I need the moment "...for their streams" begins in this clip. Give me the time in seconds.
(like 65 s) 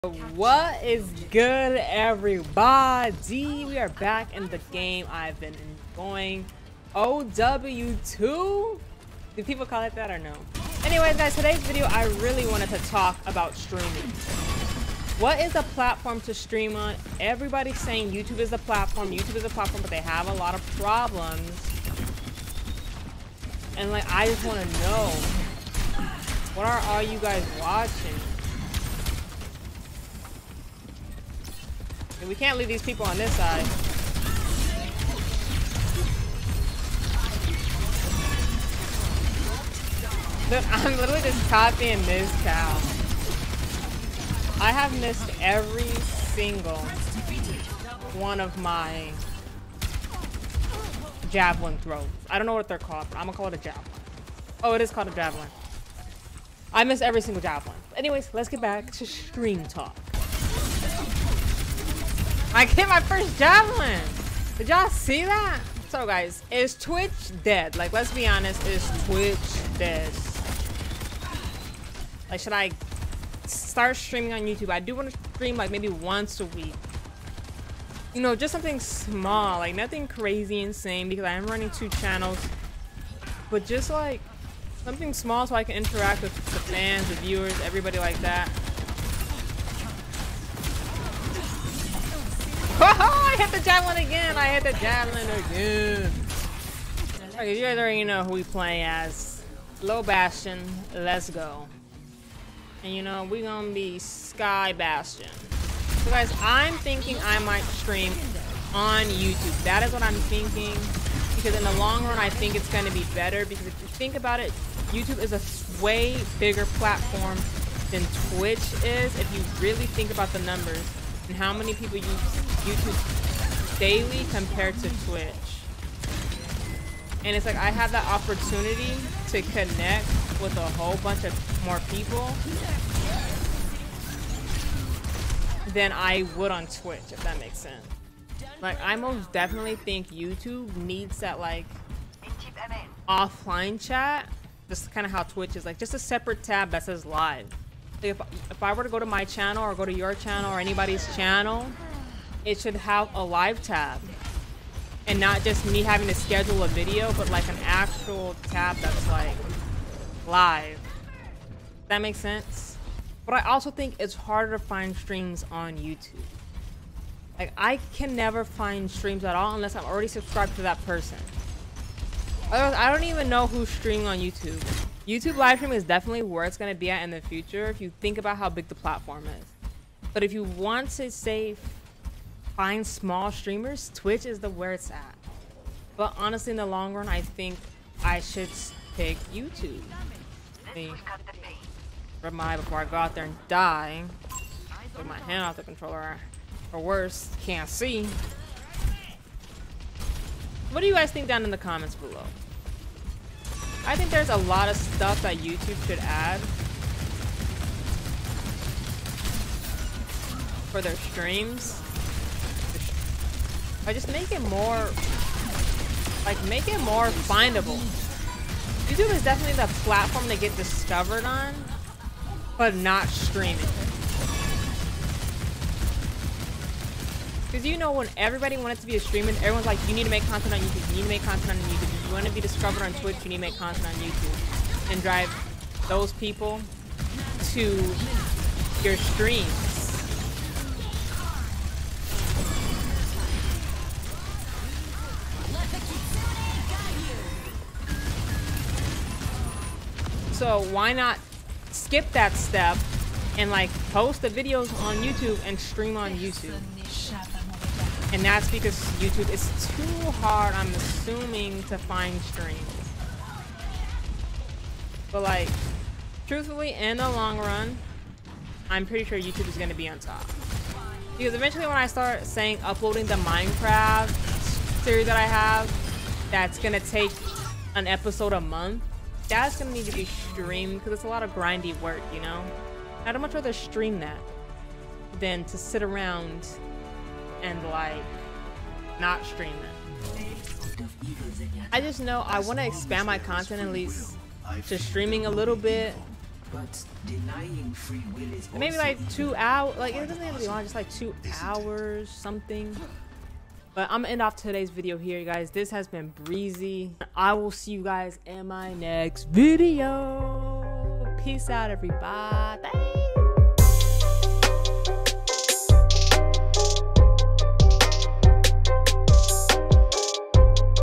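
210 s.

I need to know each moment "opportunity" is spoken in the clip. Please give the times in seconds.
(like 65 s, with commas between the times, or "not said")
128 s.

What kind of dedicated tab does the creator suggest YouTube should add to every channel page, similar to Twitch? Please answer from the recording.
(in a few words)
live tab.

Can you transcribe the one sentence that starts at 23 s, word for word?
And like, I just want to know.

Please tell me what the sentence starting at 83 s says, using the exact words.
But just like something small so I can interact with the fans, the viewers, everybody like that.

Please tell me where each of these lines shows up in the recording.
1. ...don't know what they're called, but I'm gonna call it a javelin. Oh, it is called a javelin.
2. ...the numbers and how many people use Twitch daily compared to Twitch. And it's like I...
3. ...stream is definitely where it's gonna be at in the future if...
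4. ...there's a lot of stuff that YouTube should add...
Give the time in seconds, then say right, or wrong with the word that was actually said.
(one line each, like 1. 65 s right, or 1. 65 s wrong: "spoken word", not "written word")
1. 52 s right
2. 120 s wrong: "YouTube", not "Twitch"
3. 175 s right
4. 204 s right.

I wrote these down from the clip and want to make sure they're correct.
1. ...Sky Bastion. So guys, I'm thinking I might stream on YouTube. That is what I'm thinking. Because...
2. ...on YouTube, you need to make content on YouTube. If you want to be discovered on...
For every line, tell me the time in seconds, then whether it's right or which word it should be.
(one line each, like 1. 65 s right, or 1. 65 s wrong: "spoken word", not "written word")
1. 103 s right
2. 230 s right.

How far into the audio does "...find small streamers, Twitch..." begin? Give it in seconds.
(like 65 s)
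182 s.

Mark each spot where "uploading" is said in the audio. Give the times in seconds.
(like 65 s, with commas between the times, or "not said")
272 s.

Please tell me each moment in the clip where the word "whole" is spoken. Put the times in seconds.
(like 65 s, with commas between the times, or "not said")
130 s.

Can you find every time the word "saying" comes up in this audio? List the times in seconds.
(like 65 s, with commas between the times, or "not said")
17 s, 272 s.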